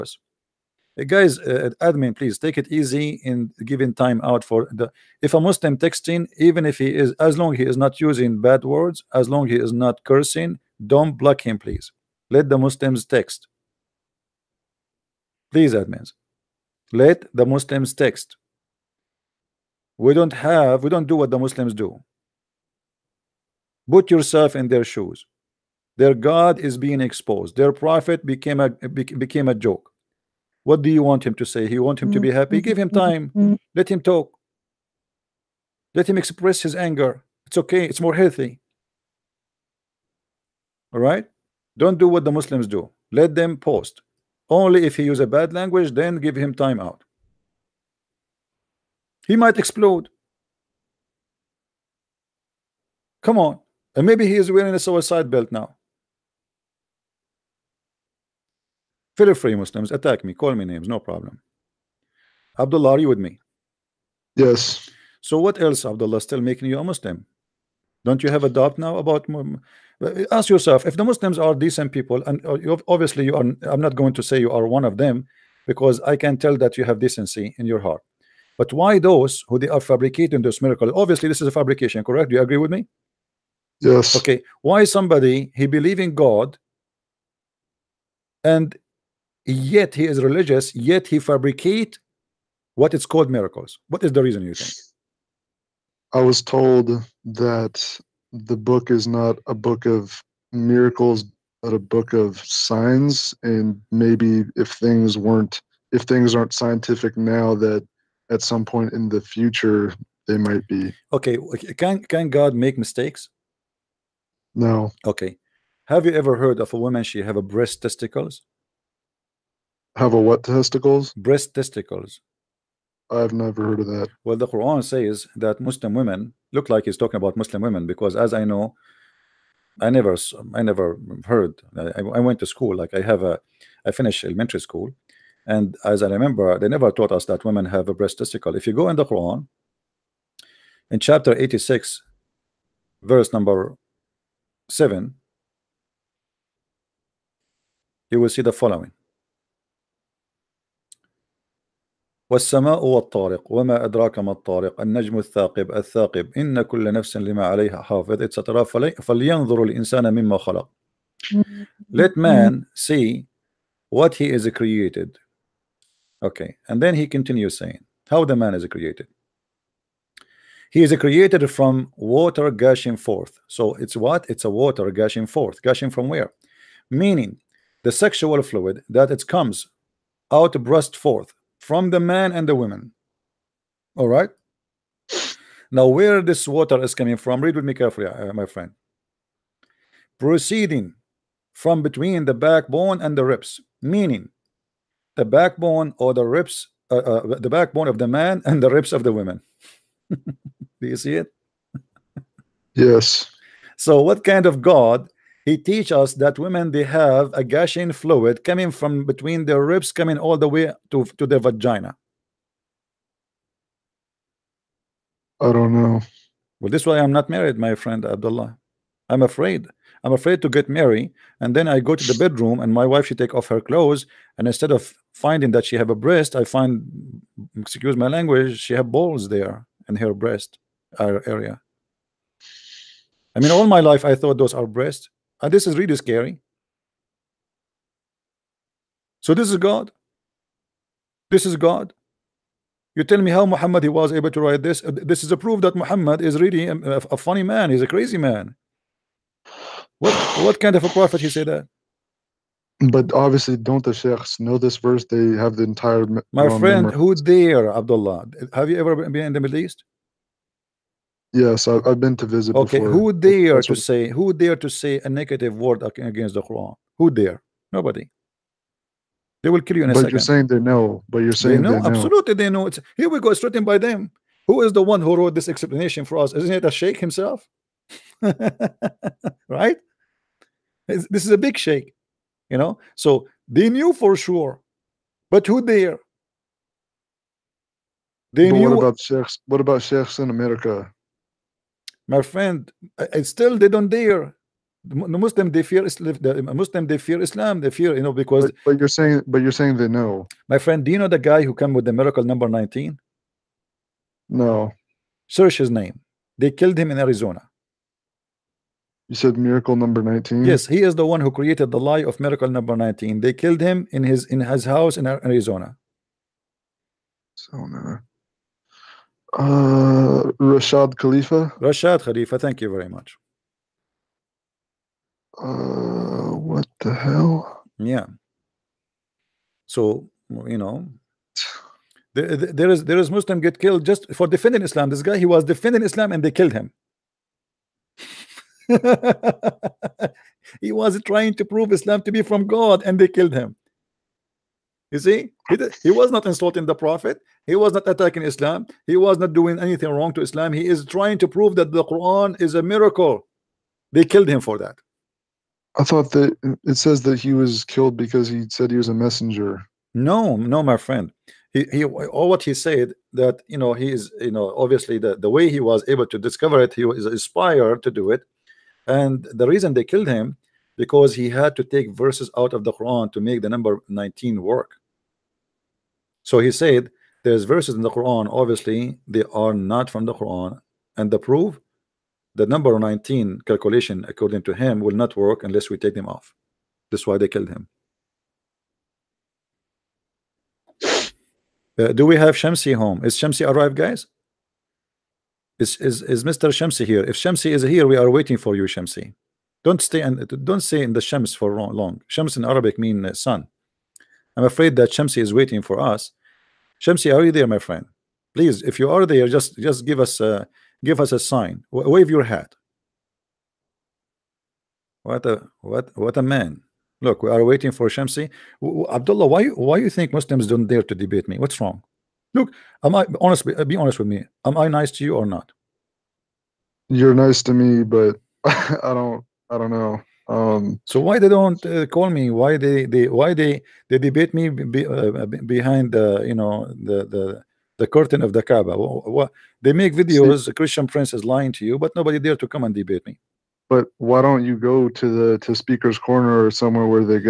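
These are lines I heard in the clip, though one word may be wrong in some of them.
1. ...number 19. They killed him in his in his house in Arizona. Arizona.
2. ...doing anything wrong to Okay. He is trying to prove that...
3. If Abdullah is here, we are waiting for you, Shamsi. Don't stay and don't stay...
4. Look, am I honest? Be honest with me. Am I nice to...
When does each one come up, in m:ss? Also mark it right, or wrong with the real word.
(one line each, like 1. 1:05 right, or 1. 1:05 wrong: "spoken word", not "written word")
1. 5:12 right
2. 5:49 wrong: "Islam", not "Okay"
3. 6:37 wrong: "Shamsi", not "Abdullah"
4. 7:02 right.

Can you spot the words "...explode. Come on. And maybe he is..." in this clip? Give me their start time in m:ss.
0:49.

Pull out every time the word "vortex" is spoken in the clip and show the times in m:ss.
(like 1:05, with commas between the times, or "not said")
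not said.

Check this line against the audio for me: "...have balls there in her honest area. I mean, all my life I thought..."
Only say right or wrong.
wrong.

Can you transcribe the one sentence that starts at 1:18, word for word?
But why those who they are fabricating this miracle?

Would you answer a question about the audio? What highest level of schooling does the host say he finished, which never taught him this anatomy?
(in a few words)
Elementary school.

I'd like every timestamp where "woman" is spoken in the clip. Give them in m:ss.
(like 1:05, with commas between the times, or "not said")
1:56, 3:02.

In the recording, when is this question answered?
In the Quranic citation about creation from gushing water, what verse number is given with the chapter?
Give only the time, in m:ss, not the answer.
2:23.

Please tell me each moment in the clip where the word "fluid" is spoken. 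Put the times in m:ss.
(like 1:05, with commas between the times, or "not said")
2:58, 3:27.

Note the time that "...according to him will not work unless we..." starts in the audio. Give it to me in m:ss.
6:24.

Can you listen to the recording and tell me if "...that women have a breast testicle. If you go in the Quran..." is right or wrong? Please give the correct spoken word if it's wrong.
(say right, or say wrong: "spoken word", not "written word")
right.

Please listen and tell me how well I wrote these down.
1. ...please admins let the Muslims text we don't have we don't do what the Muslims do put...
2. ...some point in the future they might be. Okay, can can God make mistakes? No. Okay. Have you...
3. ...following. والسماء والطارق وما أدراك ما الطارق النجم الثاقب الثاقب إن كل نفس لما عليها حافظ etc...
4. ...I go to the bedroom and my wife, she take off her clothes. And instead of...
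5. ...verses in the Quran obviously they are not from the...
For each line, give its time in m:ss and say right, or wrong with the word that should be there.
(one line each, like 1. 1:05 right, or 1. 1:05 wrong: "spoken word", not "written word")
1. 0:15 right
2. 1:48 right
3. 2:28 right
4. 3:41 right
5. 6:17 right.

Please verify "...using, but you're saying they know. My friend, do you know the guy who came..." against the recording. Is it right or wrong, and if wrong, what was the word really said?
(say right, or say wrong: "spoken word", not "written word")
wrong: "saying", not "using".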